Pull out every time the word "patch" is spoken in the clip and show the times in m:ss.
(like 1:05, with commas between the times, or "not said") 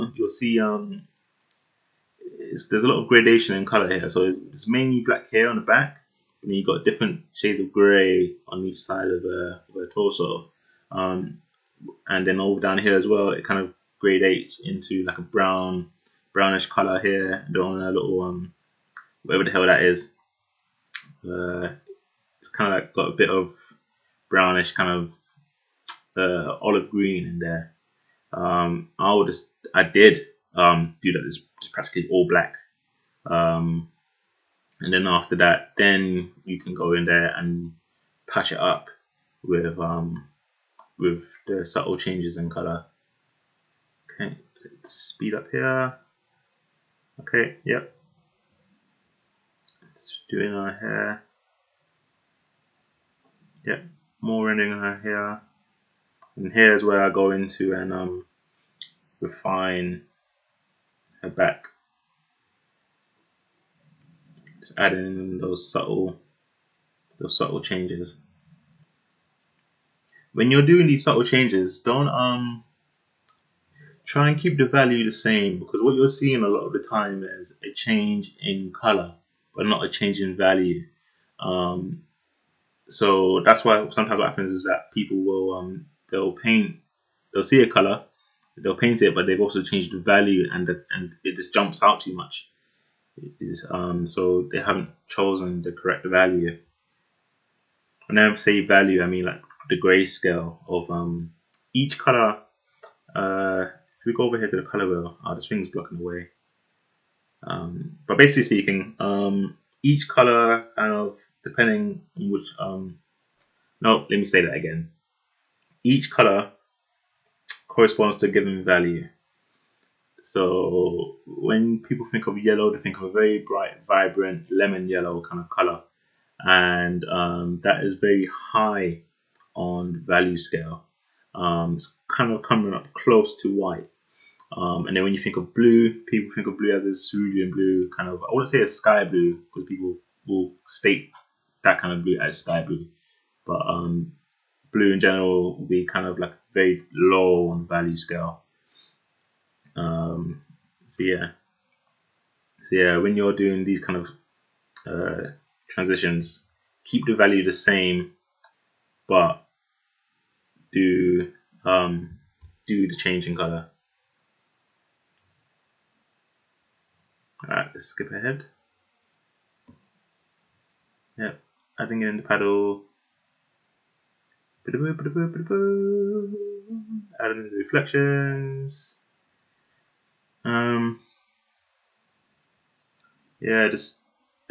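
0:38.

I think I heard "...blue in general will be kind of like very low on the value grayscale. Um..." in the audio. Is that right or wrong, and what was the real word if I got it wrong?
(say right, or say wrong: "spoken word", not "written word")
wrong: "scale", not "grayscale".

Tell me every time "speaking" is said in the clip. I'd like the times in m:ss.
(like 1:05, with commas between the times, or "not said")
1:48.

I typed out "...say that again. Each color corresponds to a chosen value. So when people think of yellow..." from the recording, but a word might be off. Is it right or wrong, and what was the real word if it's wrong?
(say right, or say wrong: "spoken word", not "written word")
wrong: "given", not "chosen".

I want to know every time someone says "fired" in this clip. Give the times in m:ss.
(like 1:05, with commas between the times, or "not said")
not said.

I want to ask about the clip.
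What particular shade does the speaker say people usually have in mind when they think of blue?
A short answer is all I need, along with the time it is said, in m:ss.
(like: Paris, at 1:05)
cerulean blue, at 2:16.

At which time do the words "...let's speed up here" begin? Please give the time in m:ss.
0:44.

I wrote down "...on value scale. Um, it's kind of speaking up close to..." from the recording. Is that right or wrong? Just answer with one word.
wrong.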